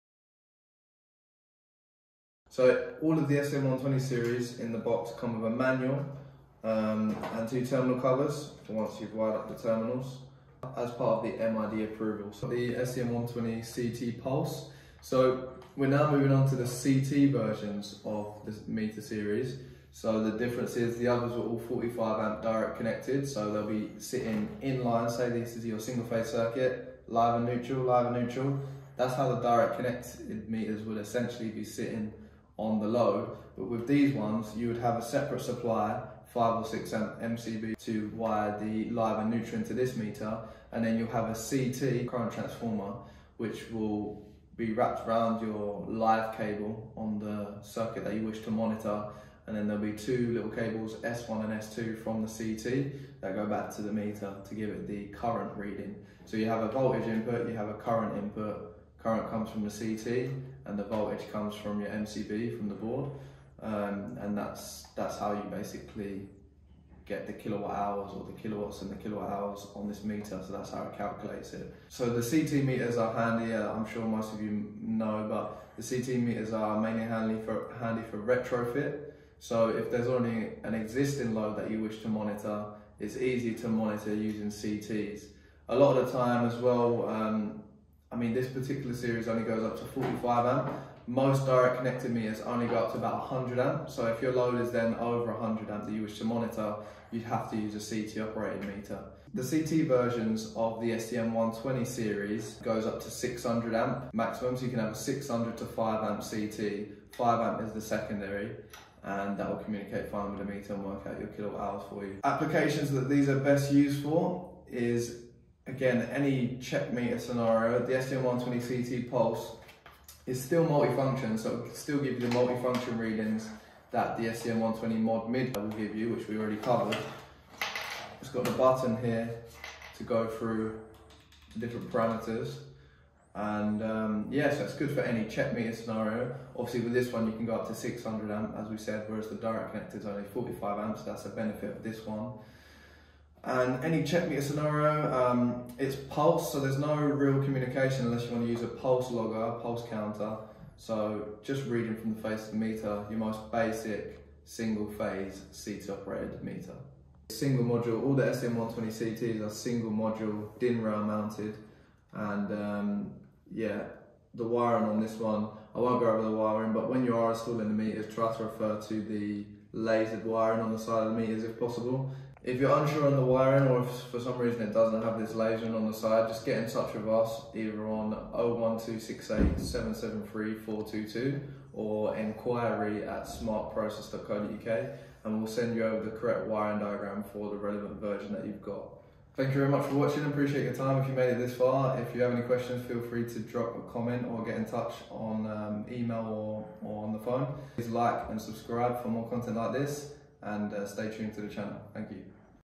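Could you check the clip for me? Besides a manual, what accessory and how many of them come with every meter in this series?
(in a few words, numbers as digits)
Two terminal covers.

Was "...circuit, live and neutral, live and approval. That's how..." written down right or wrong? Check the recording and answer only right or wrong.
wrong.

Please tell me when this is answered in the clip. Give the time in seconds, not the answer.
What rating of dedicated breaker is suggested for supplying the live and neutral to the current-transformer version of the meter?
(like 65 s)
36 s.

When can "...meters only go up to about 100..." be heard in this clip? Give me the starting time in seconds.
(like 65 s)
92 s.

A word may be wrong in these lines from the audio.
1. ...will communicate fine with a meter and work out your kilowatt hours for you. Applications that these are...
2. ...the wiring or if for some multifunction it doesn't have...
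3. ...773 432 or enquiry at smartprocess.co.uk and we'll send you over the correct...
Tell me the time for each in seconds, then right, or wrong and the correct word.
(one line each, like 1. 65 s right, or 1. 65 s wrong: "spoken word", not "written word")
1. 109 s right
2. 173 s wrong: "reason", not "multifunction"
3. 179 s wrong: "422", not "432".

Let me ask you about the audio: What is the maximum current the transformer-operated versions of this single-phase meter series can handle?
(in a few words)
600 amp.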